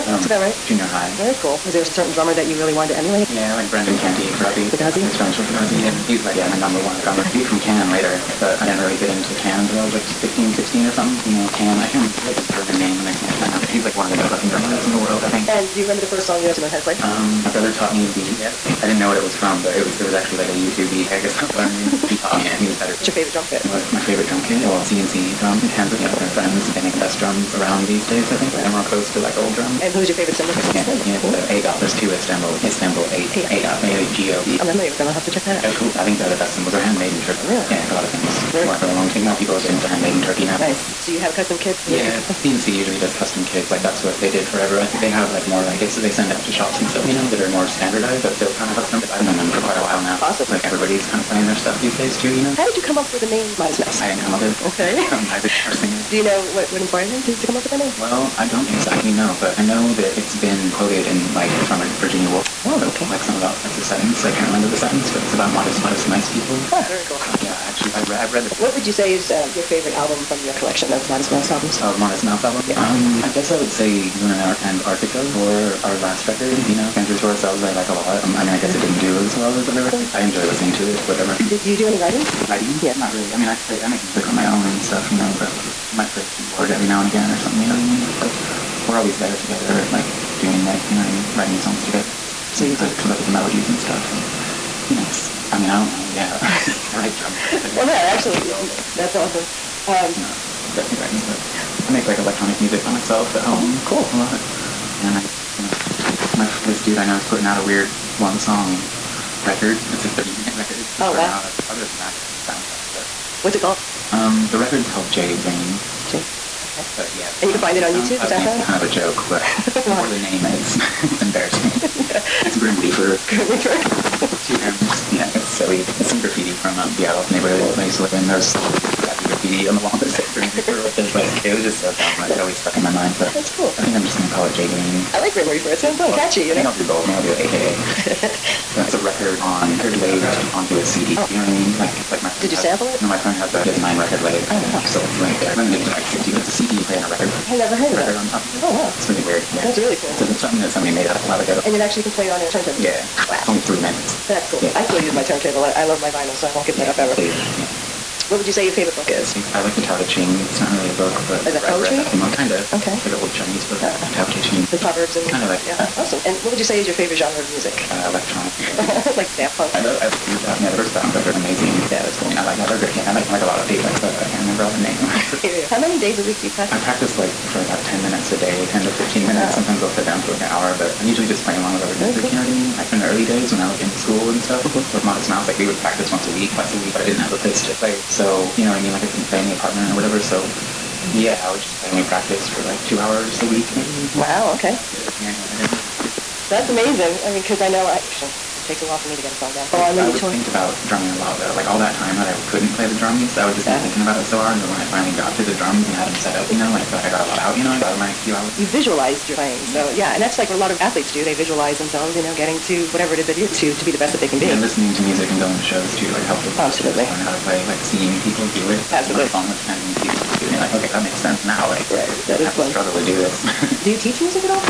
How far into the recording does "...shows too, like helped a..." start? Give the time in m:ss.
3:35.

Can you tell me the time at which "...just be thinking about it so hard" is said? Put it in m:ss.
3:23.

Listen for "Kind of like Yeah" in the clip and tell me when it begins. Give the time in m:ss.
2:45.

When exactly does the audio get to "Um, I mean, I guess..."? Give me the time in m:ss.
1:18.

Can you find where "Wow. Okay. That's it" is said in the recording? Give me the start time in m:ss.
3:14.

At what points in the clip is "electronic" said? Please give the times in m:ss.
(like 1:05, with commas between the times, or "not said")
1:42, 2:48.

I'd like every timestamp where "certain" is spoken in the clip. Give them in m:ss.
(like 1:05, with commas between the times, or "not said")
0:01.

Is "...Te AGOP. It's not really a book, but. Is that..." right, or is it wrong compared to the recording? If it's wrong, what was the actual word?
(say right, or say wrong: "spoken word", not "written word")
wrong: "Ching", not "AGOP".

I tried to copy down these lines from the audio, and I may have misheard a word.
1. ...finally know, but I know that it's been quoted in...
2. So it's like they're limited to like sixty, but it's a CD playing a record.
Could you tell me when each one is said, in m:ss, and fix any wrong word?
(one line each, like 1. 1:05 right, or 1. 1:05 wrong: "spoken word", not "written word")
1. 0:58 wrong: "exactly", not "finally"
2. 2:24 right.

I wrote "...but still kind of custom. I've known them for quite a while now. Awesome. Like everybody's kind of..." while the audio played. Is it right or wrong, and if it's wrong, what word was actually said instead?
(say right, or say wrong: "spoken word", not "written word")
right.